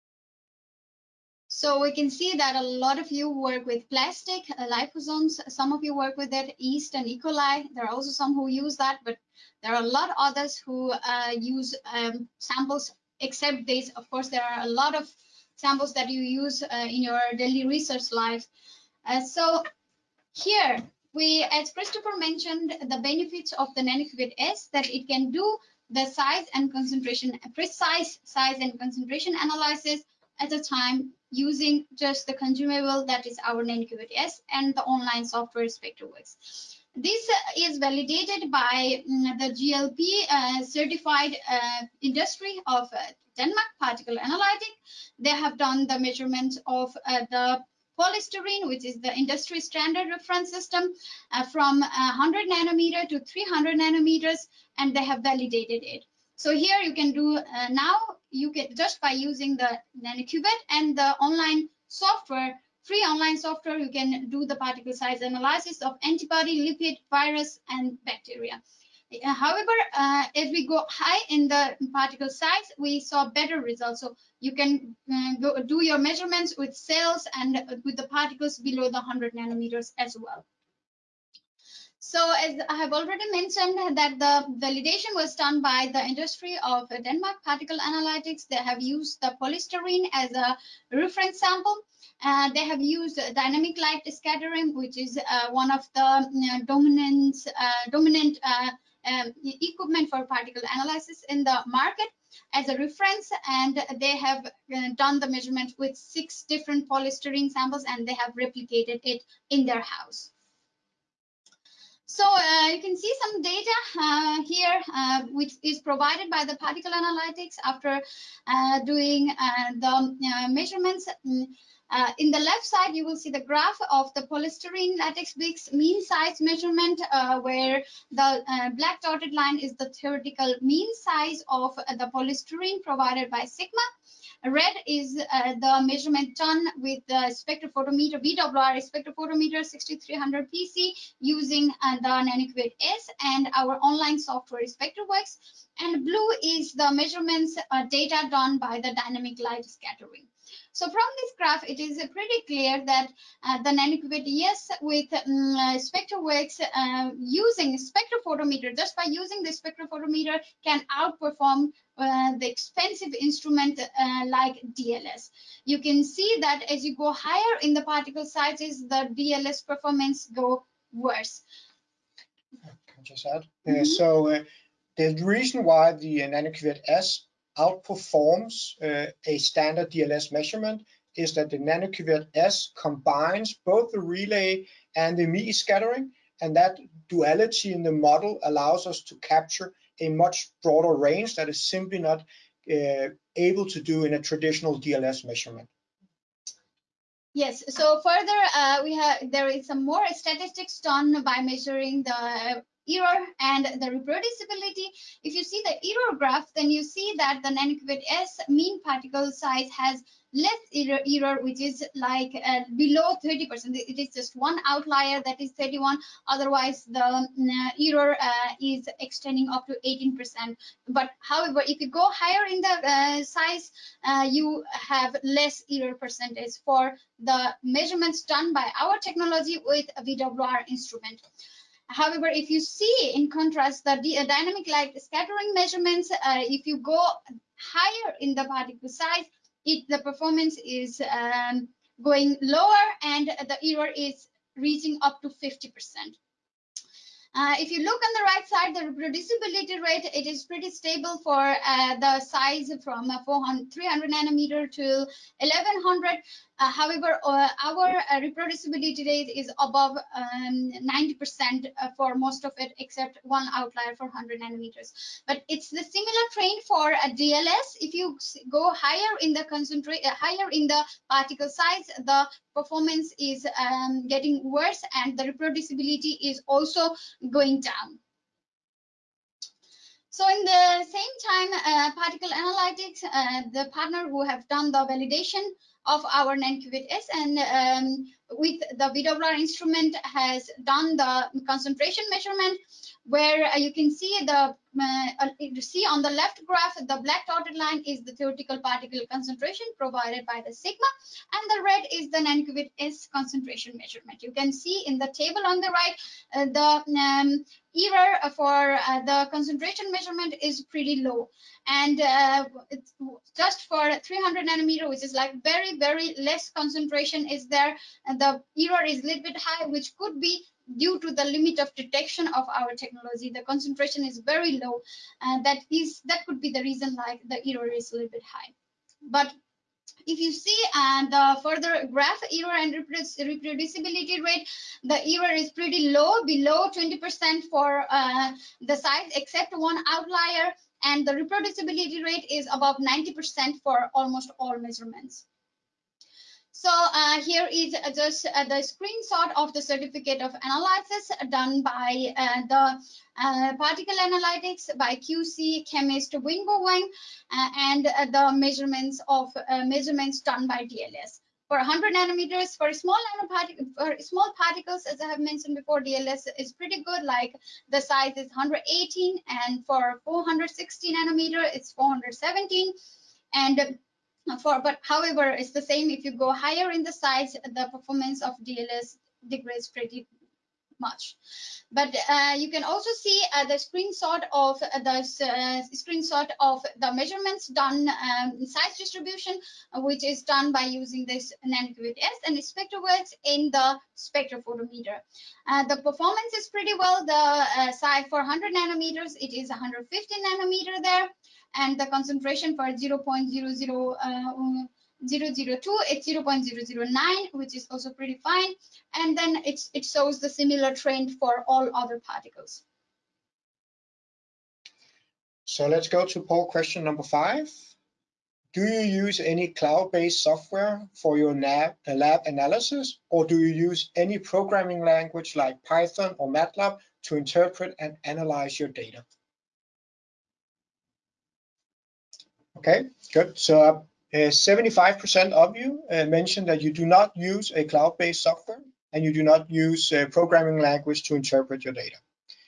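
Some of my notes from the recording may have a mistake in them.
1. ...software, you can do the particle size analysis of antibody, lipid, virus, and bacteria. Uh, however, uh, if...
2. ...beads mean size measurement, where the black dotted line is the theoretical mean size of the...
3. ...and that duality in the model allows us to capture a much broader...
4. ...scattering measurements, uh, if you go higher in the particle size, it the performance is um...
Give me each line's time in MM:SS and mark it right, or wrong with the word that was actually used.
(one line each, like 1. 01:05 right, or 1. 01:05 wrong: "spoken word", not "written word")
1. 01:03 right
2. 02:05 right
3. 03:06 right
4. 03:55 right.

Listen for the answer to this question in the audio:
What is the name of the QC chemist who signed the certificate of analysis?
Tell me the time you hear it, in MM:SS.
05:56.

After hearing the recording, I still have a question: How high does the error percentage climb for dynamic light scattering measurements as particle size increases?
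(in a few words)
50%.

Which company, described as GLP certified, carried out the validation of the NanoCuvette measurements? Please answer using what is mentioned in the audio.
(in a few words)
Particle Analytic.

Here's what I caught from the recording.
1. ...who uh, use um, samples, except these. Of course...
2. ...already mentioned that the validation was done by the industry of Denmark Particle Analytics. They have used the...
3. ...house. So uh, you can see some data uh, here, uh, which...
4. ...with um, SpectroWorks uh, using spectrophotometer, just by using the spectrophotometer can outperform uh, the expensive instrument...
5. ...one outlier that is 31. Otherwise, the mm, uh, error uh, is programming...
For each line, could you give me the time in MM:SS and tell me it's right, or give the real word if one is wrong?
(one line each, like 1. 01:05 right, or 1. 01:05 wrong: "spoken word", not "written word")
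1. 00:10 right
2. 01:22 right
3. 01:49 right
4. 02:34 right
5. 03:34 wrong: "extending", not "programming".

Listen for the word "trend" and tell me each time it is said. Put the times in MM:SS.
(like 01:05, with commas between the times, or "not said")
04:26, 06:50.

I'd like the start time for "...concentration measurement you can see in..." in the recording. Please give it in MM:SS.
05:03.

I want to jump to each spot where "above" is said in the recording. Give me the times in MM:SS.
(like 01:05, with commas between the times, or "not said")
04:19, 05:42.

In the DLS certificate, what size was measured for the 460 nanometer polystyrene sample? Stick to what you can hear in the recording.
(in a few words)
417.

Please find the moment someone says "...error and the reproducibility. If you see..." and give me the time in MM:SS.
03:22.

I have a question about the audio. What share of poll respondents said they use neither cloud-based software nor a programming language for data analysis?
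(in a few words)
75%.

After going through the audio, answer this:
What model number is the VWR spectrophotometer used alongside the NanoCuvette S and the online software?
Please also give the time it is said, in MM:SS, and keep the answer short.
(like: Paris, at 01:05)
6300 PC, at 02:19.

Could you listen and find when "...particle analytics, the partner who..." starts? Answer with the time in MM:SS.
04:41.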